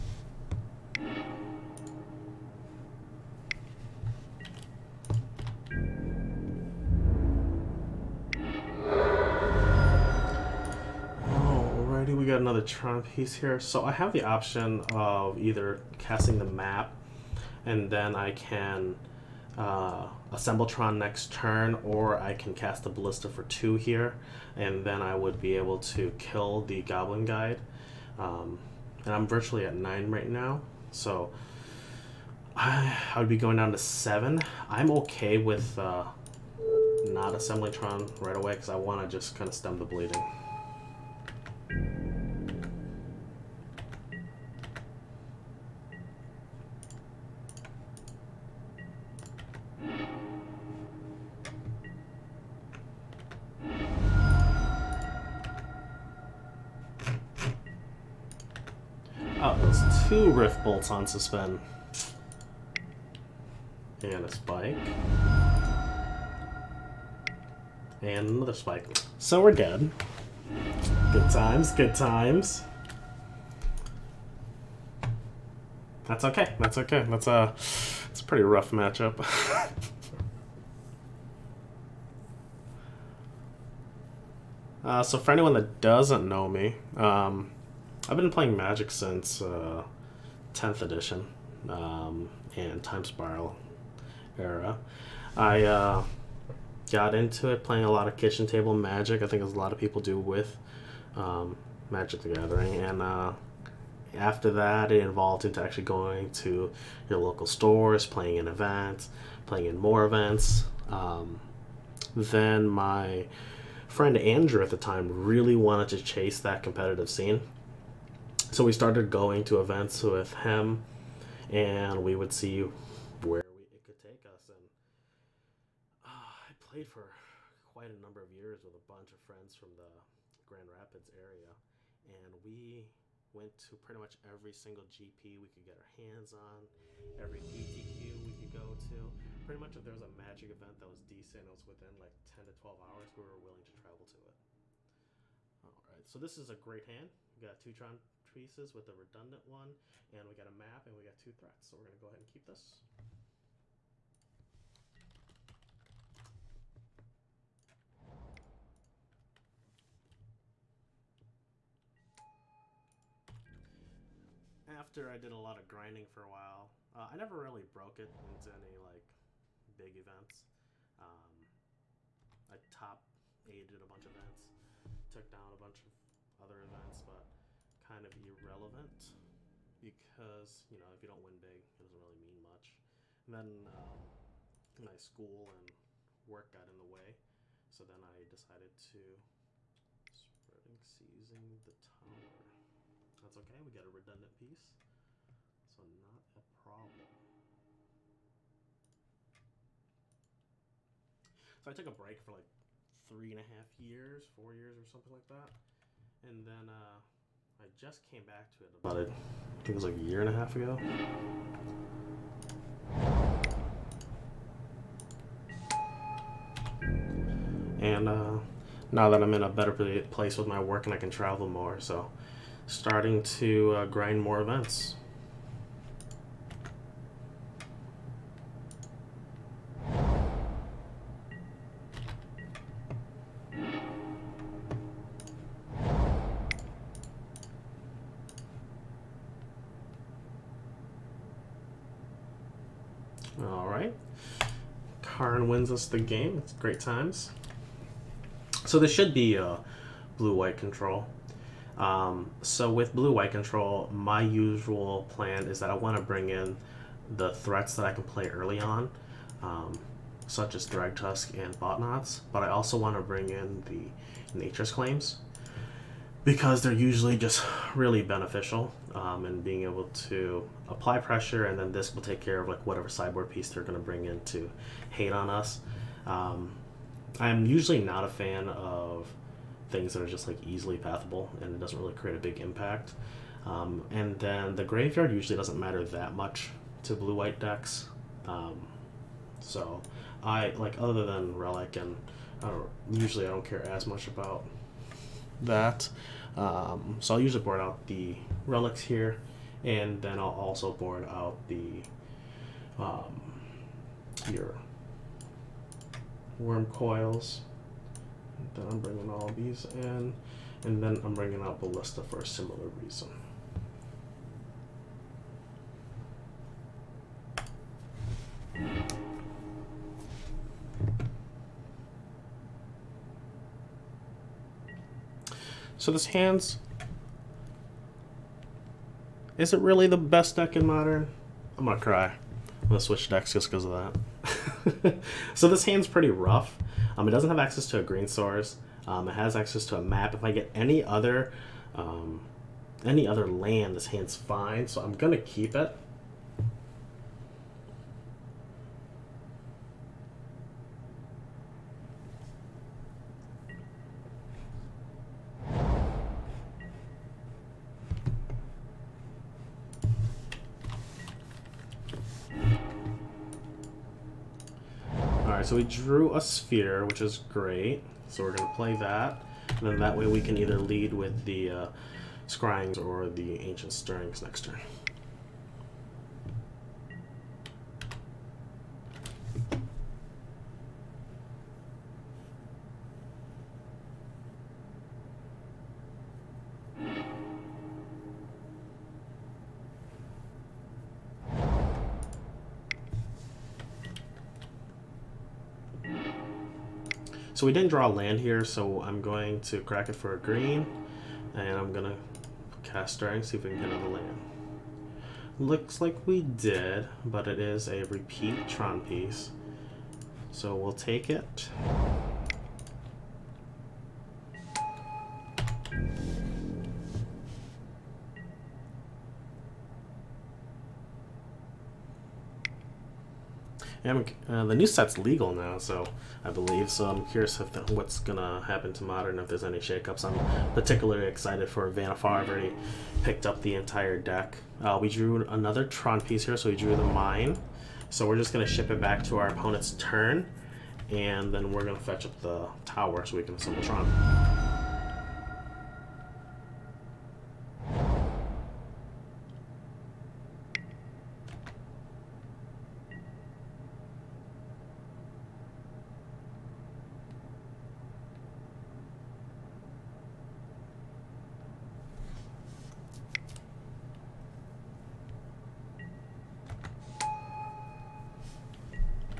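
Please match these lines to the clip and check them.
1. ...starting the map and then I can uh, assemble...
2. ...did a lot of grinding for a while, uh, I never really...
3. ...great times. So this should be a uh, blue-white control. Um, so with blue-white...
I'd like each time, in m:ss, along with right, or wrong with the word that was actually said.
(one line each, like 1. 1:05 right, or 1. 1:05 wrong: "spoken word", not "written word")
1. 0:15 wrong: "casting", not "starting"
2. 2:45 right
3. 4:06 right.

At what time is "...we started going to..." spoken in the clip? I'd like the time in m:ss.
1:58.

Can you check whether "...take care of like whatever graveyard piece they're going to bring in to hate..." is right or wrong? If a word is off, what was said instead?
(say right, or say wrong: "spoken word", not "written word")
wrong: "sideboard", not "graveyard".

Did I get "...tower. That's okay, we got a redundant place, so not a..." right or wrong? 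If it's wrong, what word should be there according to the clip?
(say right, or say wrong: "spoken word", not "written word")
wrong: "piece", not "place".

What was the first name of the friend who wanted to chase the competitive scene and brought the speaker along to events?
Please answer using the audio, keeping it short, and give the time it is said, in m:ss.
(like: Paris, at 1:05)
Andrew, at 1:54.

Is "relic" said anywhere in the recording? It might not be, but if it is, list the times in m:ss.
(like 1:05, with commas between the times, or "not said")
4:51, 4:58.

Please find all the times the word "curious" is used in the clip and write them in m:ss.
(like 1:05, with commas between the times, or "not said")
7:07.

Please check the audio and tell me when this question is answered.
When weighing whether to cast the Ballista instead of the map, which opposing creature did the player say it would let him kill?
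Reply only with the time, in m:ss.
0:26.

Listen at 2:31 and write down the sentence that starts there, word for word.
So we're gonna go ahead and keep this.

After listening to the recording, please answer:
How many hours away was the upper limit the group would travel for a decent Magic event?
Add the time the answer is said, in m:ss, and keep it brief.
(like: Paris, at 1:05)
12, at 2:22.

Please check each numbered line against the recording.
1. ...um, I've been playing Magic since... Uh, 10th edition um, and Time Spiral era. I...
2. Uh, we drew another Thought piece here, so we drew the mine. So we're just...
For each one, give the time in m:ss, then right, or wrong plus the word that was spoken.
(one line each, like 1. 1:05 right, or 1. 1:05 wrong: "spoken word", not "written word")
1. 1:26 right
2. 7:14 wrong: "Tron", not "Thought".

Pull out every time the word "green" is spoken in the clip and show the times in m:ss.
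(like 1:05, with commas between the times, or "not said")
5:37, 6:40.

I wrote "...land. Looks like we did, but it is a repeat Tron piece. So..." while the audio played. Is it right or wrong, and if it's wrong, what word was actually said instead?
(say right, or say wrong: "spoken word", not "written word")
right.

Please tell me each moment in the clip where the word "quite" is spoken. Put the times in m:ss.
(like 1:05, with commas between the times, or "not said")
2:07.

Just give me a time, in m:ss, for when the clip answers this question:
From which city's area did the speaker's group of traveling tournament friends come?
2:10.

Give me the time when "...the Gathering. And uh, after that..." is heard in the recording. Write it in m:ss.
1:42.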